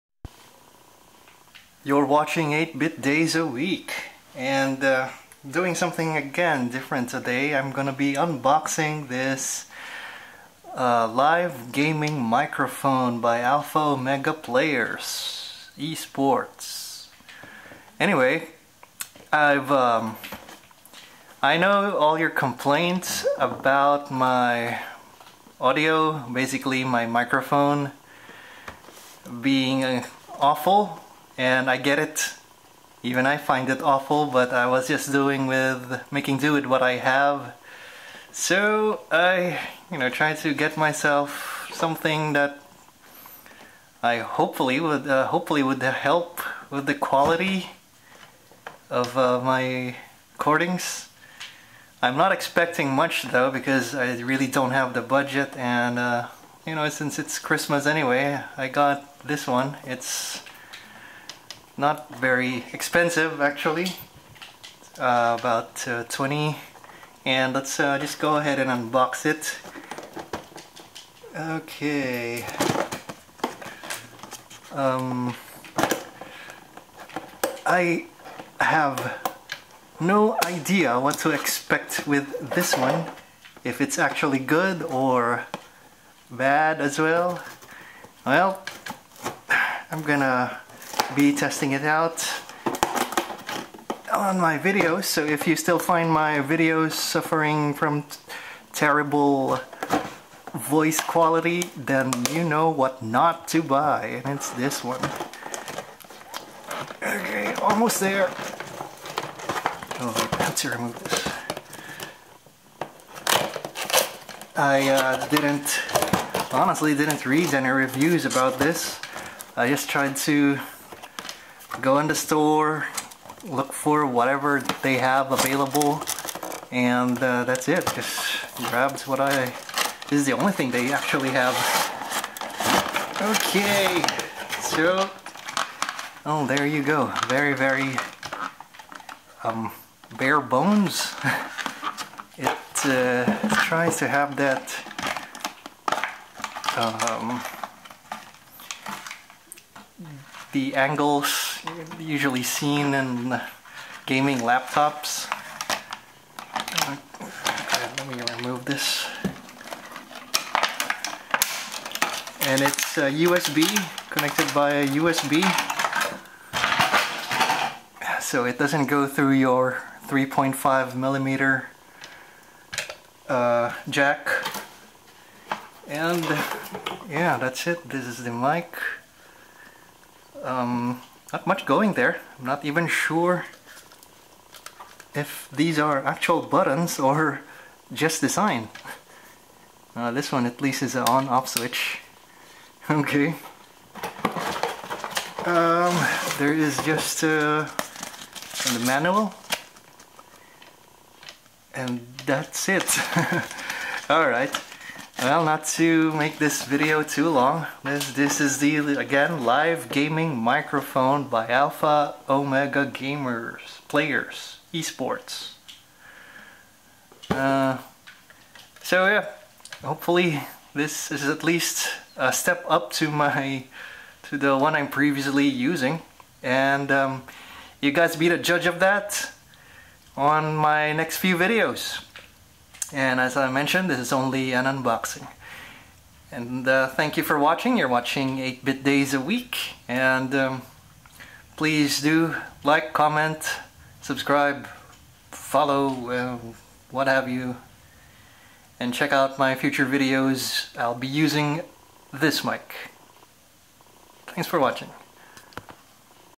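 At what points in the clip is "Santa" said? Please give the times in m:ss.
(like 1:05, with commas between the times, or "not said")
not said.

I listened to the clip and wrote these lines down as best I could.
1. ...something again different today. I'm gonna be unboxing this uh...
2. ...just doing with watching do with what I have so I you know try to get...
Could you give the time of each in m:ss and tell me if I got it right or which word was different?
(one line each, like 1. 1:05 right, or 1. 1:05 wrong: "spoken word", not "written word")
1. 0:05 right
2. 0:34 wrong: "making", not "watching".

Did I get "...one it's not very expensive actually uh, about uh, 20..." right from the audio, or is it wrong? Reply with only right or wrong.
right.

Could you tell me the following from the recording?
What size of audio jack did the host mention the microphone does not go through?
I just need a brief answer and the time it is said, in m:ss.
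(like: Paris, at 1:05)
3.5 millimeter, at 2:50.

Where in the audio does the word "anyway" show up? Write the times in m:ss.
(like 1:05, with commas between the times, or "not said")
0:17, 0:57.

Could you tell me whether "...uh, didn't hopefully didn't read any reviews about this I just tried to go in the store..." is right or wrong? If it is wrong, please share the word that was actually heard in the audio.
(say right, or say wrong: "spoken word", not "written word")
wrong: "honestly", not "hopefully".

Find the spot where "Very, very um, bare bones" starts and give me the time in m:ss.
2:17.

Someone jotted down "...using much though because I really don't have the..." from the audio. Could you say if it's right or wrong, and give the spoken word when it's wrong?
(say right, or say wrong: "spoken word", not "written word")
wrong: "expecting", not "using".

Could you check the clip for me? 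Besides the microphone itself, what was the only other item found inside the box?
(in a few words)
the manual.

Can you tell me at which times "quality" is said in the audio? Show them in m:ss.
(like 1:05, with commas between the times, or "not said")
0:46, 1:41.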